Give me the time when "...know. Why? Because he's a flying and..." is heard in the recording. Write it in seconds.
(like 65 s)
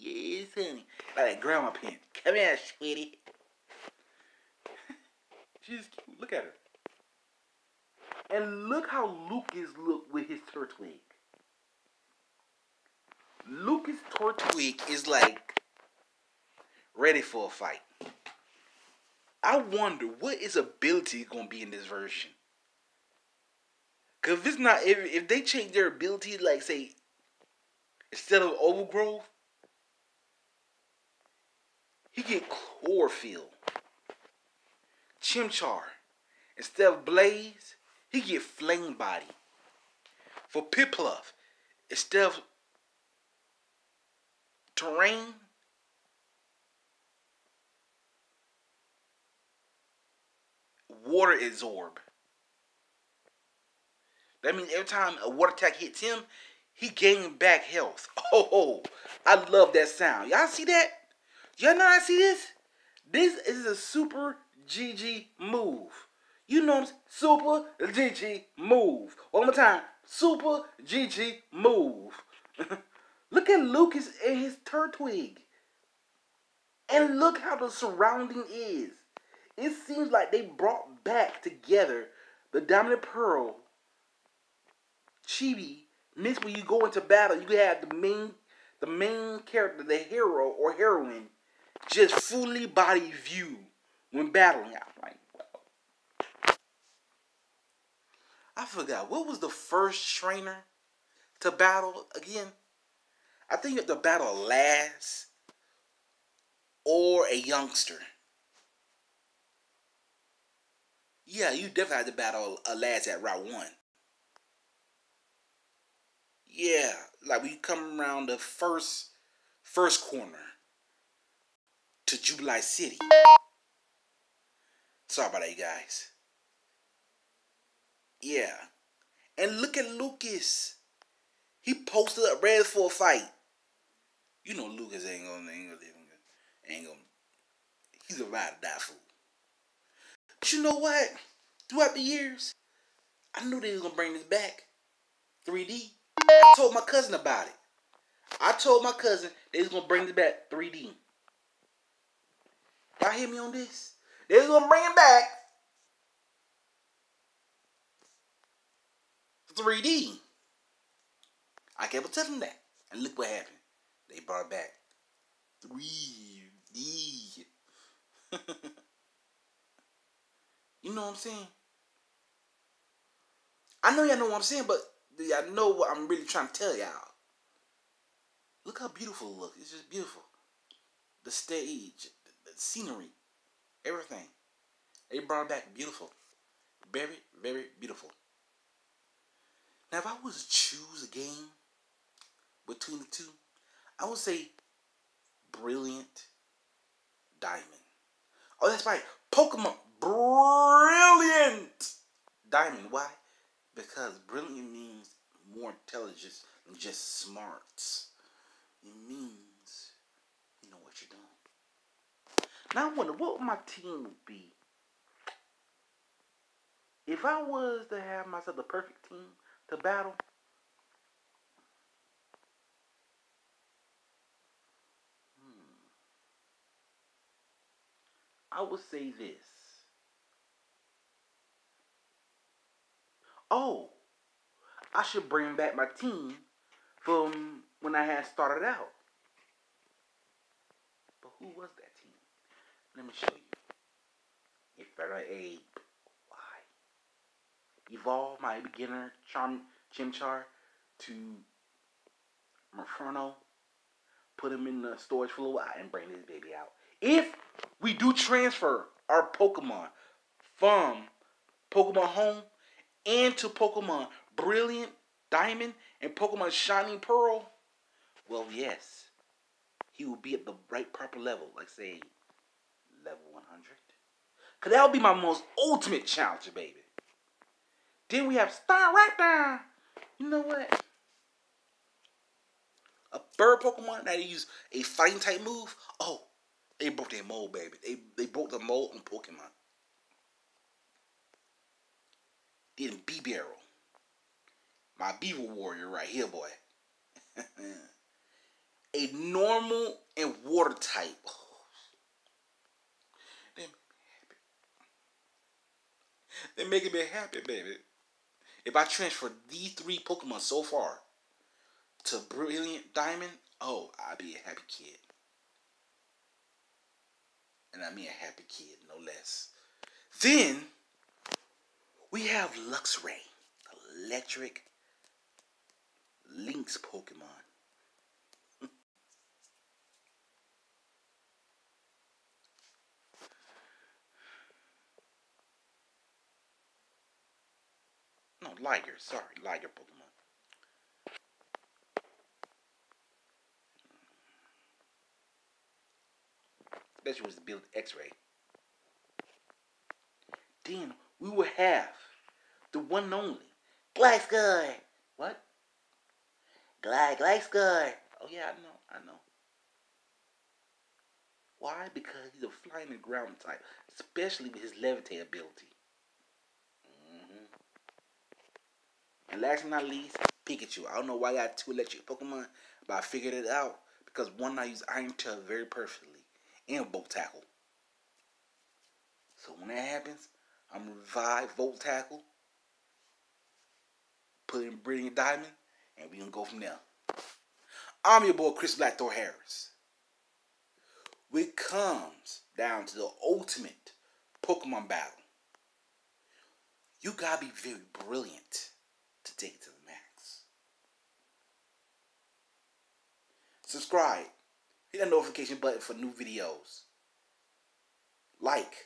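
359 s.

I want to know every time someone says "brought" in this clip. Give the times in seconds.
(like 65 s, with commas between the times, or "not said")
80 s, 164 s, 185 s.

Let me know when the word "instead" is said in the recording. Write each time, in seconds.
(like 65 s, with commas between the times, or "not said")
28 s, 36 s, 41 s.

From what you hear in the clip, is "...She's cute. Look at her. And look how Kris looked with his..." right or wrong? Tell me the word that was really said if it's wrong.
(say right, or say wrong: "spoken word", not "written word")
wrong: "Lucas", not "Kris".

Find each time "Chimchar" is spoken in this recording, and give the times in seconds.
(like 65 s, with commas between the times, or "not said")
35 s, 249 s.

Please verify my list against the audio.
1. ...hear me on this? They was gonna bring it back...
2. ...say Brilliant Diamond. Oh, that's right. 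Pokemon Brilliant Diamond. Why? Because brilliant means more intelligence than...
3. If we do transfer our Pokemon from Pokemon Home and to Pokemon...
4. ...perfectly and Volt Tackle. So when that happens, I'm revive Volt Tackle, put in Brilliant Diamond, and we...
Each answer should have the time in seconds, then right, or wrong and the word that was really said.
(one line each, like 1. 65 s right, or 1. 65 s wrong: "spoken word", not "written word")
1. 153 s right
2. 194 s right
3. 256 s right
4. 375 s right.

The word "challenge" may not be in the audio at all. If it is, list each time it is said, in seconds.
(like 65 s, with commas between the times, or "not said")
276 s.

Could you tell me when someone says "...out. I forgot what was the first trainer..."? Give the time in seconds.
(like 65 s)
94 s.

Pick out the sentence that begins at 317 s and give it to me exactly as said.
And I mean a happy kid, no less.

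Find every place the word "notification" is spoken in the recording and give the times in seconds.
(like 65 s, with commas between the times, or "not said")
405 s.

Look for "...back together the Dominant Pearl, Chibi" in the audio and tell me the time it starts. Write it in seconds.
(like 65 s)
81 s.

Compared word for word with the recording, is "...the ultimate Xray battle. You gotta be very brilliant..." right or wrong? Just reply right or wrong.
wrong.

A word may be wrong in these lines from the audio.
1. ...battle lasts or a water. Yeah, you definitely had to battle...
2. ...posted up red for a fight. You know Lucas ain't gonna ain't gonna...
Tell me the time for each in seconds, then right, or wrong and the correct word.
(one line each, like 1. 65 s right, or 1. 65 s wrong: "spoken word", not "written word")
1. 103 s wrong: "youngster", not "water"
2. 131 s right.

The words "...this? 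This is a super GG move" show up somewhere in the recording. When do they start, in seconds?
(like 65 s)
62 s.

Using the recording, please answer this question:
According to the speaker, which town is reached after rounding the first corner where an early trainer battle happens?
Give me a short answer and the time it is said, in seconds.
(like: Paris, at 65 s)
Jubilife City, at 122 s.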